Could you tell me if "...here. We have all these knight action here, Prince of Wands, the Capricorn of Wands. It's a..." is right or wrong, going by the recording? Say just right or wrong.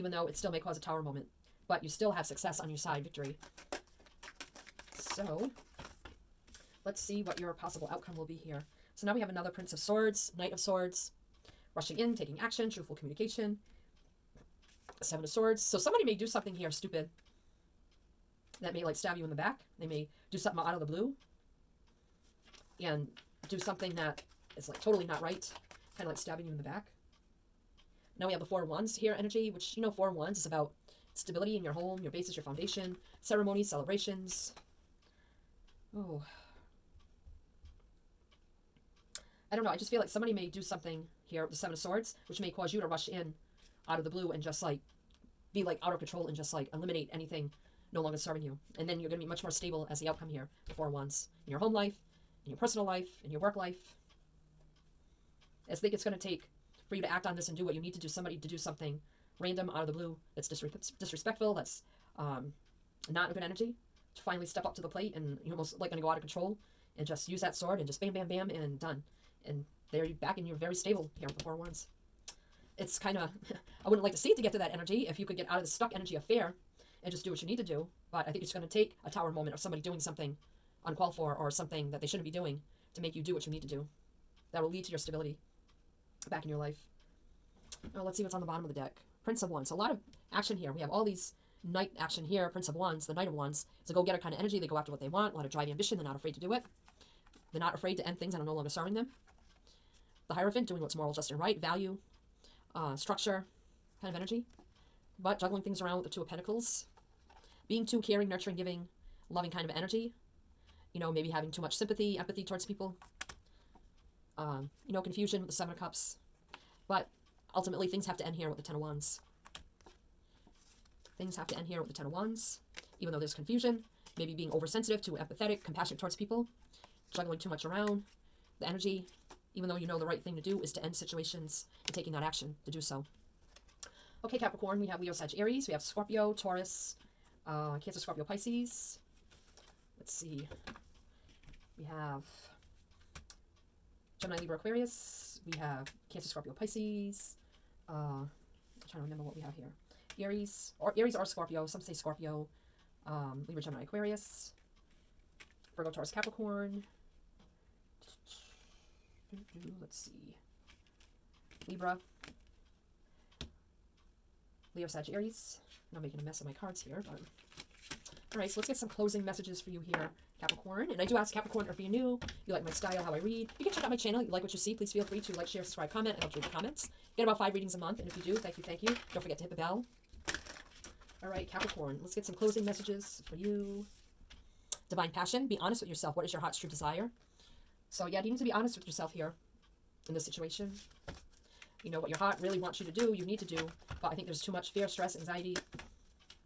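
wrong.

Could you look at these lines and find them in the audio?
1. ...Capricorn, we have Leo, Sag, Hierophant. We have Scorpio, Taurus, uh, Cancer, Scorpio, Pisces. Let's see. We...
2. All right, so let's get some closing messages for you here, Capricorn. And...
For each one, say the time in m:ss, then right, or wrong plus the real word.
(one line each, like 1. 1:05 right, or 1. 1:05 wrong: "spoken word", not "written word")
1. 2:14 wrong: "Aries", not "Hierophant"
2. 2:48 right.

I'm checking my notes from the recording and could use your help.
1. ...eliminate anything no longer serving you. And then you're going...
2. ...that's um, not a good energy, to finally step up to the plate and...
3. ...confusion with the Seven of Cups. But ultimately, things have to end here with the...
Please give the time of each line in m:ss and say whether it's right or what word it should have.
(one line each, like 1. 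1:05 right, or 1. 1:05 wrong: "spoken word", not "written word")
1. 0:46 right
2. 1:01 right
3. 1:55 right.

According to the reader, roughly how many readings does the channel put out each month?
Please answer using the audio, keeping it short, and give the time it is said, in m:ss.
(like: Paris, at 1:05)
5, at 2:57.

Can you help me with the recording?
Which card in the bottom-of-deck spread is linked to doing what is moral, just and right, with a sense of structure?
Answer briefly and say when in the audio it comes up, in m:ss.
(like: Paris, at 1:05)
The Hierophant, at 1:40.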